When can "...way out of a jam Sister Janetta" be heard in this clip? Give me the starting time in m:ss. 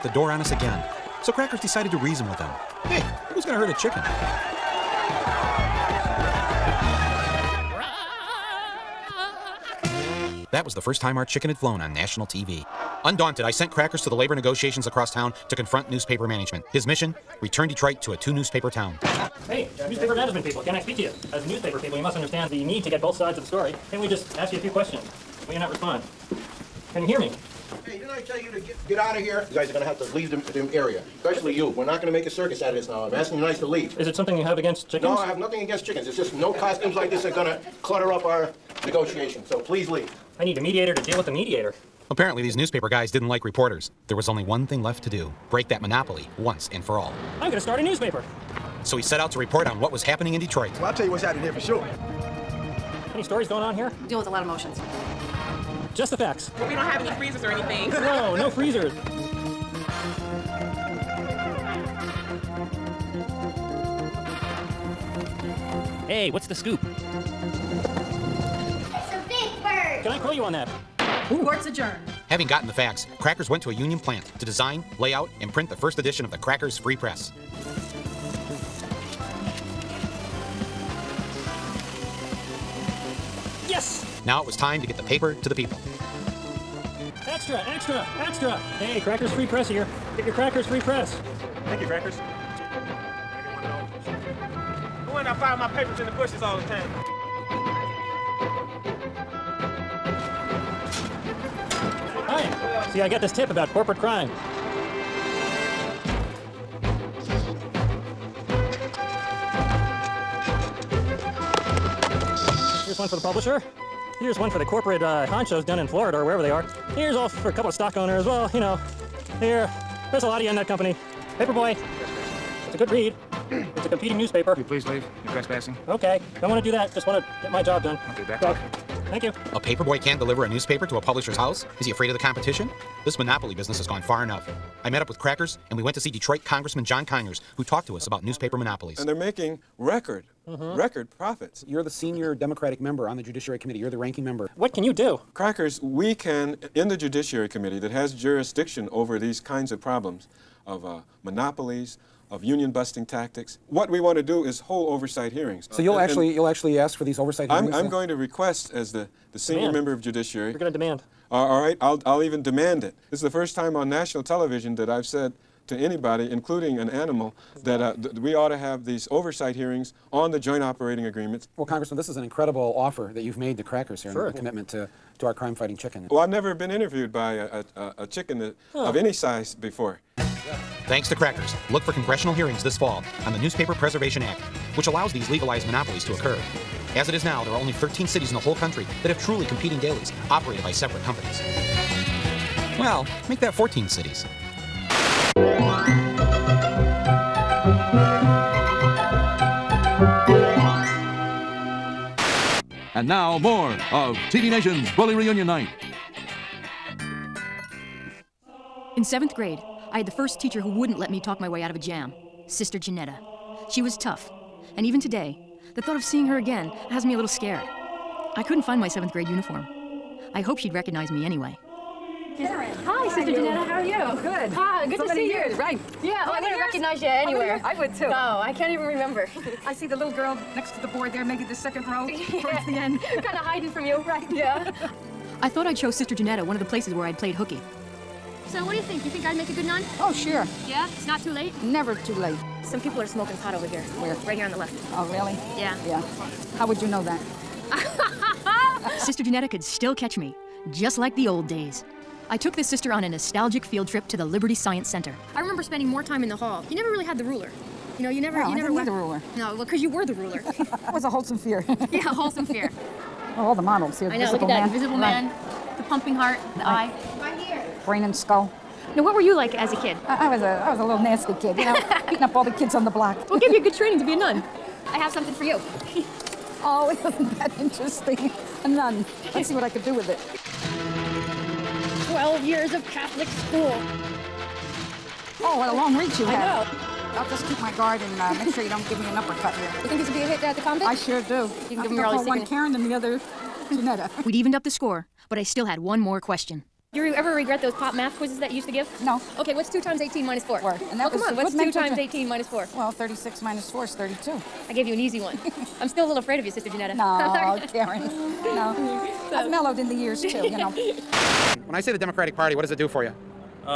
3:31.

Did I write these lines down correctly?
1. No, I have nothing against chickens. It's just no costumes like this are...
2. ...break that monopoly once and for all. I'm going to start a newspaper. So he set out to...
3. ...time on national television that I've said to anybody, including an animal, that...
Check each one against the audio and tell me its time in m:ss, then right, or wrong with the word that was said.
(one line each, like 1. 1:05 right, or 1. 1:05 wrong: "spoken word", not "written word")
1. 0:35 right
2. 0:45 right
3. 2:43 right.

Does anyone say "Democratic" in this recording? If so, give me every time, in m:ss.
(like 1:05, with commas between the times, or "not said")
2:22, 5:11.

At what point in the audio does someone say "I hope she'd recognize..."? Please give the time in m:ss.
3:40.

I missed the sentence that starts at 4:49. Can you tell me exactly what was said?
You think this would be a hit at the convict?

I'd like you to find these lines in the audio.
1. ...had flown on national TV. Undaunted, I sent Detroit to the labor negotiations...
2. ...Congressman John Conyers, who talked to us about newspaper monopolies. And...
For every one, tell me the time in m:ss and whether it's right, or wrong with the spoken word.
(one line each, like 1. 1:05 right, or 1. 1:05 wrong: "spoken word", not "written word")
1. 0:11 wrong: "Crackers", not "Detroit"
2. 2:16 right.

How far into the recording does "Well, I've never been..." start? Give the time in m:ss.
2:56.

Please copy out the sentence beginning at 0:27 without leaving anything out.
Hey, didn't I tell you to get, get out of here?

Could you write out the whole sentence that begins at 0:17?
returned Detroit to a two newspaper town.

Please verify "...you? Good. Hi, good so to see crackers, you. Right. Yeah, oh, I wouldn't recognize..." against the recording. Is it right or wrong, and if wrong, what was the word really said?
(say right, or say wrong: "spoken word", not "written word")
wrong: "years", not "crackers".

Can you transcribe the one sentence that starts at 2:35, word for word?
So you'll and, actually and you'll actually ask for these oversight hearings.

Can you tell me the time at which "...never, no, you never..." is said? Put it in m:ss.
4:18.